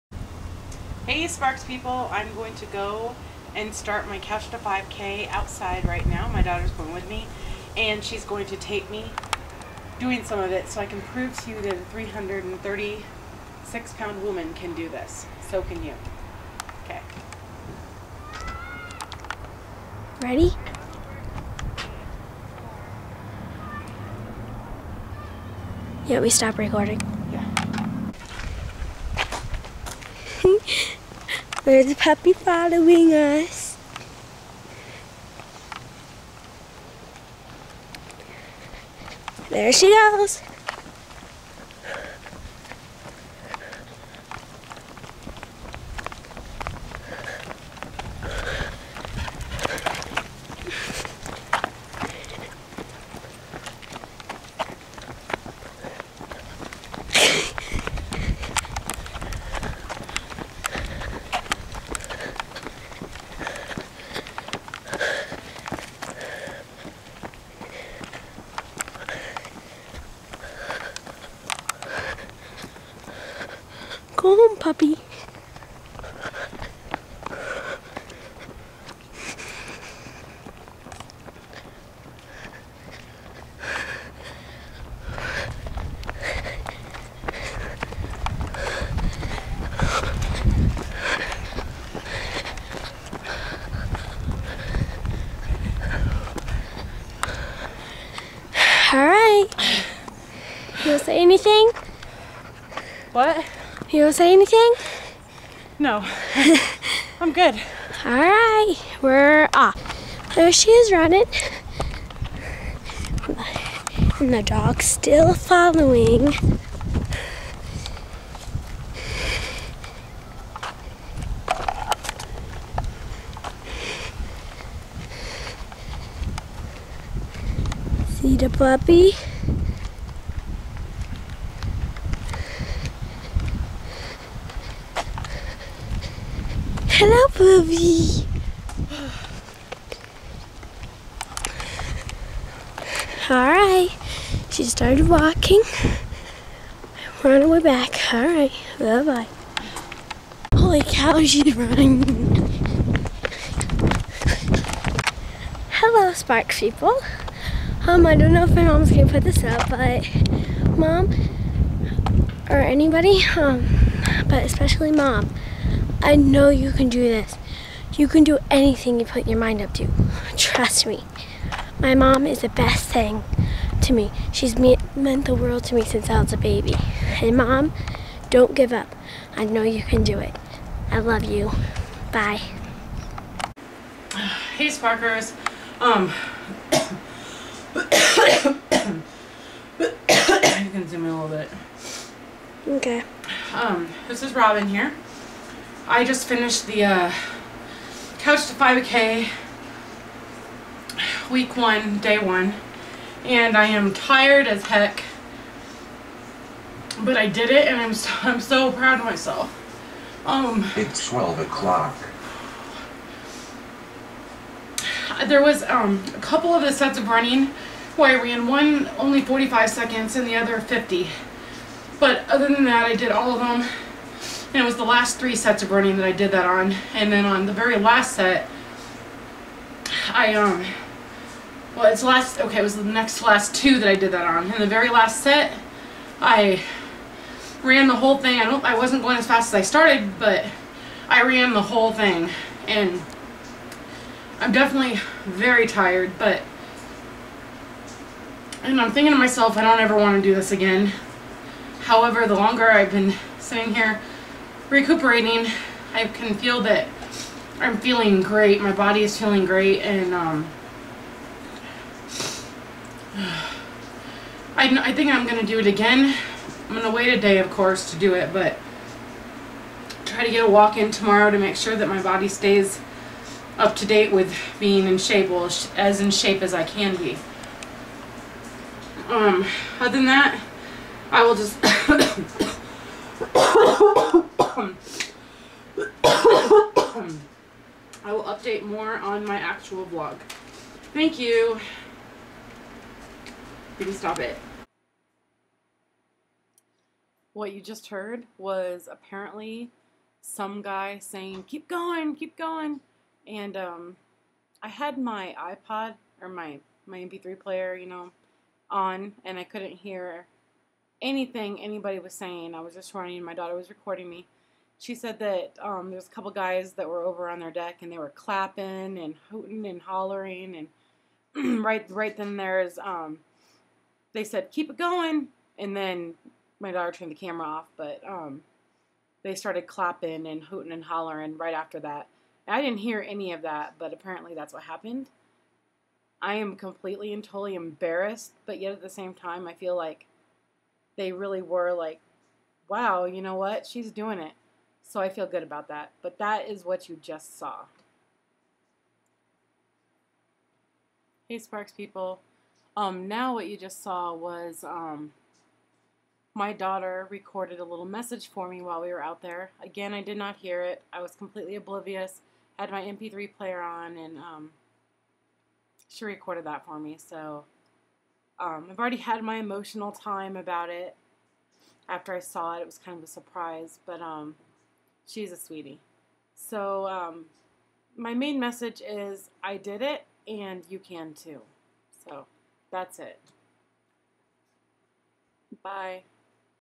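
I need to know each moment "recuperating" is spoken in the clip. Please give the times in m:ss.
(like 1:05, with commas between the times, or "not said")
4:14.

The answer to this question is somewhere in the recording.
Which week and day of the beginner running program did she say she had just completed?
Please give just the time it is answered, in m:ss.
3:21.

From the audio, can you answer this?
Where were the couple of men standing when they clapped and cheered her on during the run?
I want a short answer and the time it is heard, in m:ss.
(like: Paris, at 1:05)
On their deck, at 5:17.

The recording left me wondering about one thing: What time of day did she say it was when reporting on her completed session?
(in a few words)
12 o'clock.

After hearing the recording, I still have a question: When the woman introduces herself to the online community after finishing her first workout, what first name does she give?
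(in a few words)
Robin.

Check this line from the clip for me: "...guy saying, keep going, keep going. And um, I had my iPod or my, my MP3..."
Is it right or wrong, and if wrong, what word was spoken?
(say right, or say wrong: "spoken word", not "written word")
right.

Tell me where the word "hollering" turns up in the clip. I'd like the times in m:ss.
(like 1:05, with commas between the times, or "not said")
5:19, 5:30.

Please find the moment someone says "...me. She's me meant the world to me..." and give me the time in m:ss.
2:53.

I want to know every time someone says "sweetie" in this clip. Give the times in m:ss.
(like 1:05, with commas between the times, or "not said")
6:15.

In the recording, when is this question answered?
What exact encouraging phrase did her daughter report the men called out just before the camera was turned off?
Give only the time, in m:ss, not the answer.
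5:24.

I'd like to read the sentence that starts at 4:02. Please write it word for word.
And I'm definitely very tired, but, and I'm thinking to myself, I don't ever want to do this again.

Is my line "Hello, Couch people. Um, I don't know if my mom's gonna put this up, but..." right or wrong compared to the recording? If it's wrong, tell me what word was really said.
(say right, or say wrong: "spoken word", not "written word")
wrong: "Sparks", not "Couch".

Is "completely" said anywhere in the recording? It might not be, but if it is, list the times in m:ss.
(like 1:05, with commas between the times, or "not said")
5:36, 6:01.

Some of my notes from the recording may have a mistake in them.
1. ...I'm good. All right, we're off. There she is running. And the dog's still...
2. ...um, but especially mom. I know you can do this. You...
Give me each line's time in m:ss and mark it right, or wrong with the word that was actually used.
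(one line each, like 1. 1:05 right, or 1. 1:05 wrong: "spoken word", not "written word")
1. 1:47 right
2. 2:43 right.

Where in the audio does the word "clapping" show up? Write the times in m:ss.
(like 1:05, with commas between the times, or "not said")
5:18, 5:29.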